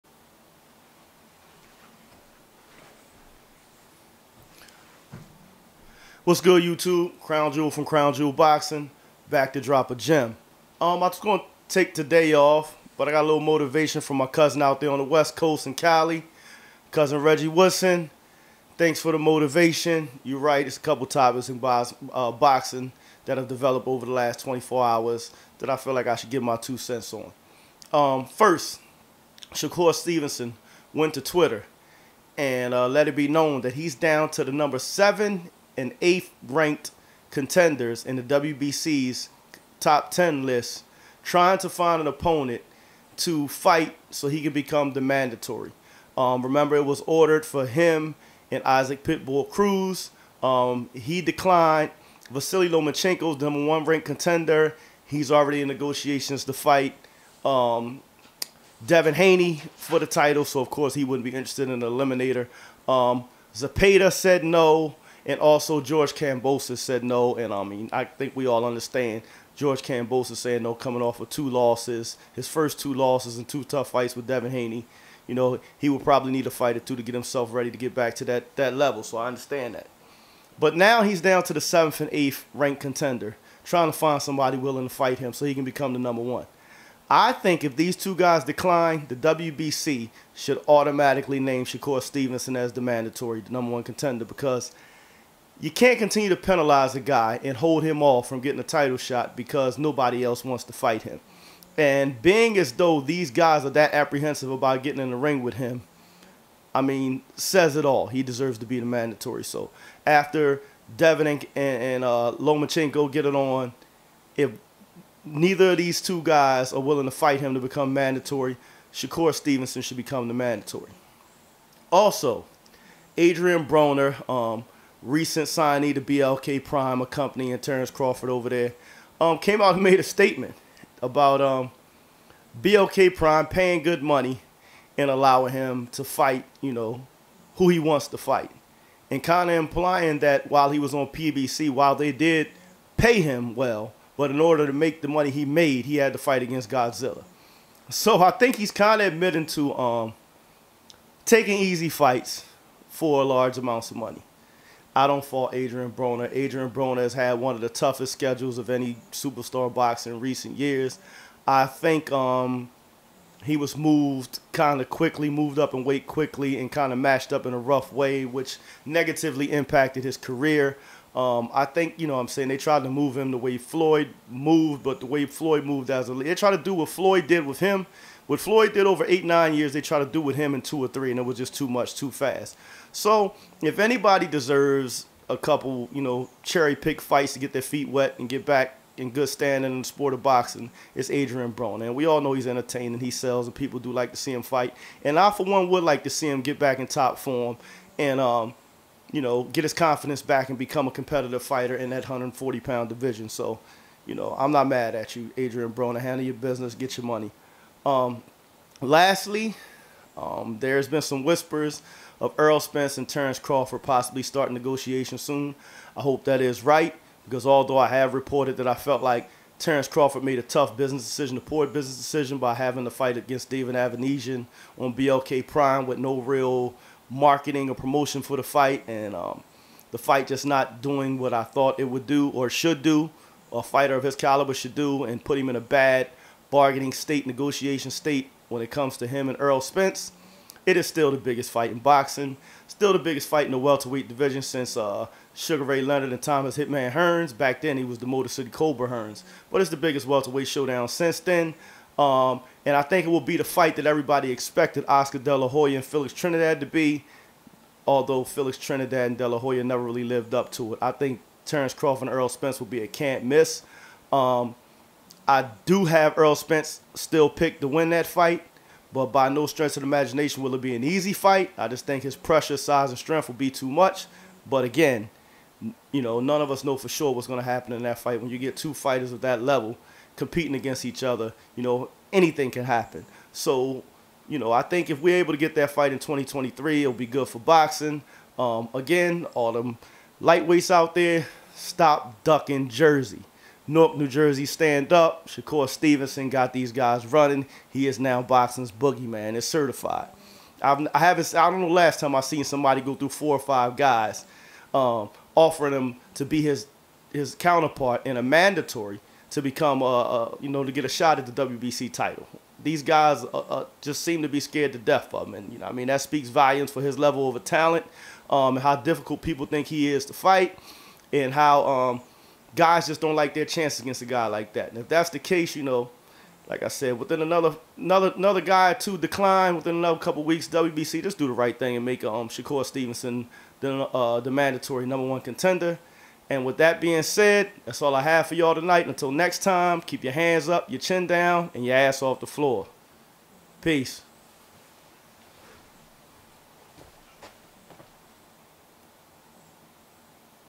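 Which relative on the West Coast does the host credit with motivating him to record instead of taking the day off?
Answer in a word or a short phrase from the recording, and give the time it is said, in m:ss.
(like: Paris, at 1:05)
Reggie Woodson, at 0:17.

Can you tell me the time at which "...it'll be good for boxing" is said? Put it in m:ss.
4:46.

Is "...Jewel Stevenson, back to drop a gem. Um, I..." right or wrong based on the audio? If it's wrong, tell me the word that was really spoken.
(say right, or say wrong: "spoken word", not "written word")
wrong: "Boxing", not "Stevenson".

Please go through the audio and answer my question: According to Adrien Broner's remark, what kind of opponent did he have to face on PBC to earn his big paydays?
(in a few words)
Godzilla.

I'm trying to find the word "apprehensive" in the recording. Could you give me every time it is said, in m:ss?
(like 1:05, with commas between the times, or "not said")
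1:43.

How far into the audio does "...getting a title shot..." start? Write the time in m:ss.
1:38.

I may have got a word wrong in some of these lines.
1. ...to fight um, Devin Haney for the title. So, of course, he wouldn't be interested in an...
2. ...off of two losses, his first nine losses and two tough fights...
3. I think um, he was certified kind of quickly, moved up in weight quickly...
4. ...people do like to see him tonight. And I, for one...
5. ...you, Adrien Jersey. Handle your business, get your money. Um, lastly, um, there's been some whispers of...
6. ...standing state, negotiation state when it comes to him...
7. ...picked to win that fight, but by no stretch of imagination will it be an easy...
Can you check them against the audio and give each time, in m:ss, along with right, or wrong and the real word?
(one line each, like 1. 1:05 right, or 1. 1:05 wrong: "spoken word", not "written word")
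1. 0:56 right
2. 1:11 wrong: "two", not "nine"
3. 2:41 wrong: "moved", not "certified"
4. 3:13 wrong: "fight", not "tonight"
5. 3:25 wrong: "Broner", not "Jersey"
6. 3:56 wrong: "bargaining", not "standing"
7. 4:27 right.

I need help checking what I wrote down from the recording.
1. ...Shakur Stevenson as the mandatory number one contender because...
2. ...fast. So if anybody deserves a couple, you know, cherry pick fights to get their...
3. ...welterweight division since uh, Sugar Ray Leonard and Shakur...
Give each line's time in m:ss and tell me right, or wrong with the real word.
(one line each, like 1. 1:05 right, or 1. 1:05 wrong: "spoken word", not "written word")
1. 1:31 right
2. 3:02 right
3. 4:03 wrong: "Thomas", not "Shakur".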